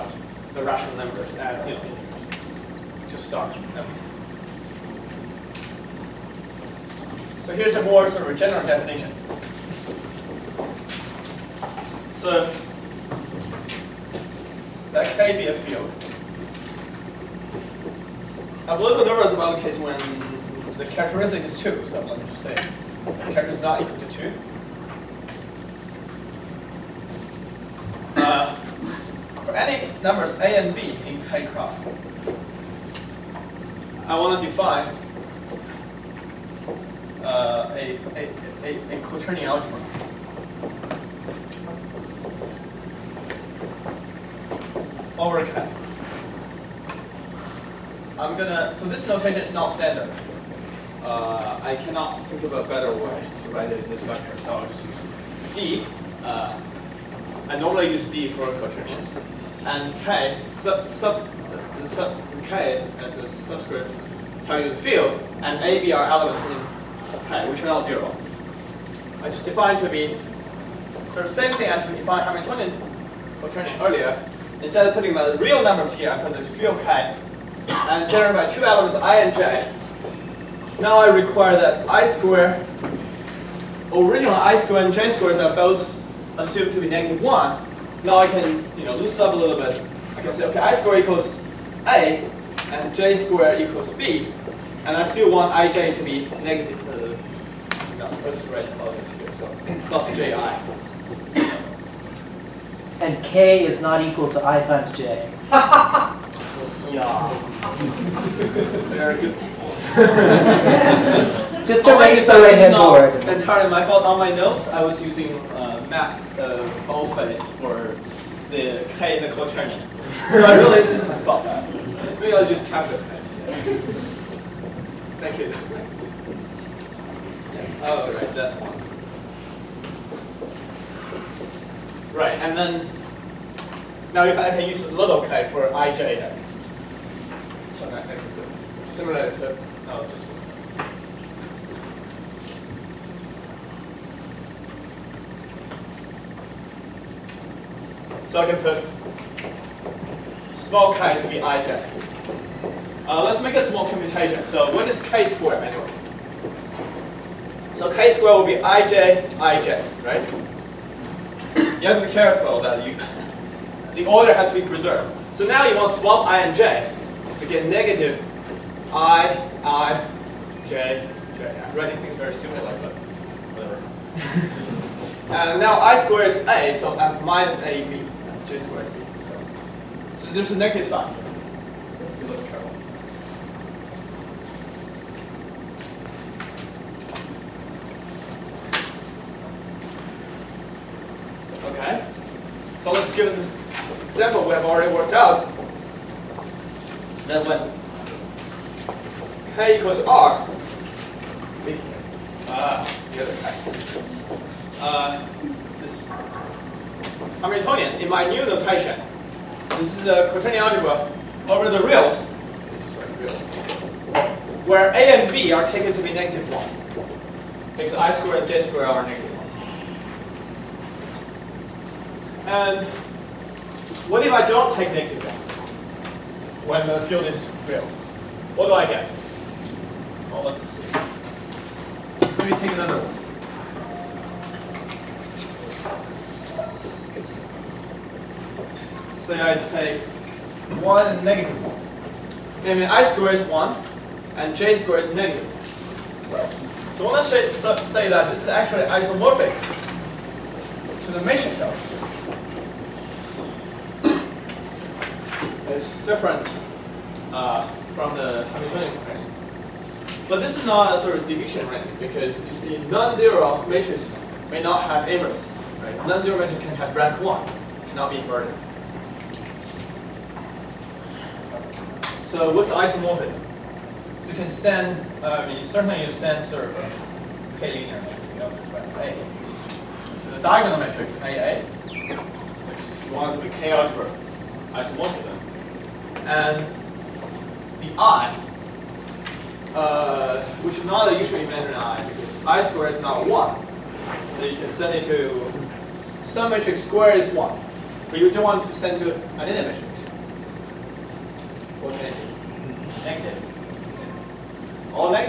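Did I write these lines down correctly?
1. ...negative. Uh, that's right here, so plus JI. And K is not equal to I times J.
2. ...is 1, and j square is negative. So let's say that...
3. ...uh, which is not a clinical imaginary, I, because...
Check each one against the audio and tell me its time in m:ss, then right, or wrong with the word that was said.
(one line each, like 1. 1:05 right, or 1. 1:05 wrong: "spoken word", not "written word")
1. 1:36 right
2. 4:03 right
3. 4:49 wrong: "usual", not "clinical".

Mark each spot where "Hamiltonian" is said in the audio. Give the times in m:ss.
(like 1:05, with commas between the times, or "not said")
1:12, 3:27, 4:18.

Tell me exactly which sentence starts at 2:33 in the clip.
Uh, let's make a small commutation.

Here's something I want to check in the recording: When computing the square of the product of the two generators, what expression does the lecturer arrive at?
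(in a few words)
minus ab.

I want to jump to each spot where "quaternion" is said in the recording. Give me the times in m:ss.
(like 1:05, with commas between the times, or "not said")
0:39, 0:58, 3:30.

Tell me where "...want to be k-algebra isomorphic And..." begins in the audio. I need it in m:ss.
4:43.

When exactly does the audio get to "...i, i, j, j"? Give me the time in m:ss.
2:48.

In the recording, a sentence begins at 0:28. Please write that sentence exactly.
Uh, for any numbers A and B in K cross.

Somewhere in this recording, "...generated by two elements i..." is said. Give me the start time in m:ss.
1:18.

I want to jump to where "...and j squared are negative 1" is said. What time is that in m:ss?
3:38.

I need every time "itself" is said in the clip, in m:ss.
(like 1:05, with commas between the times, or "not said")
4:11.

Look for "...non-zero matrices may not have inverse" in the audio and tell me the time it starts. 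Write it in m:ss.
4:22.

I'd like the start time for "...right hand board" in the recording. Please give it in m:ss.
1:52.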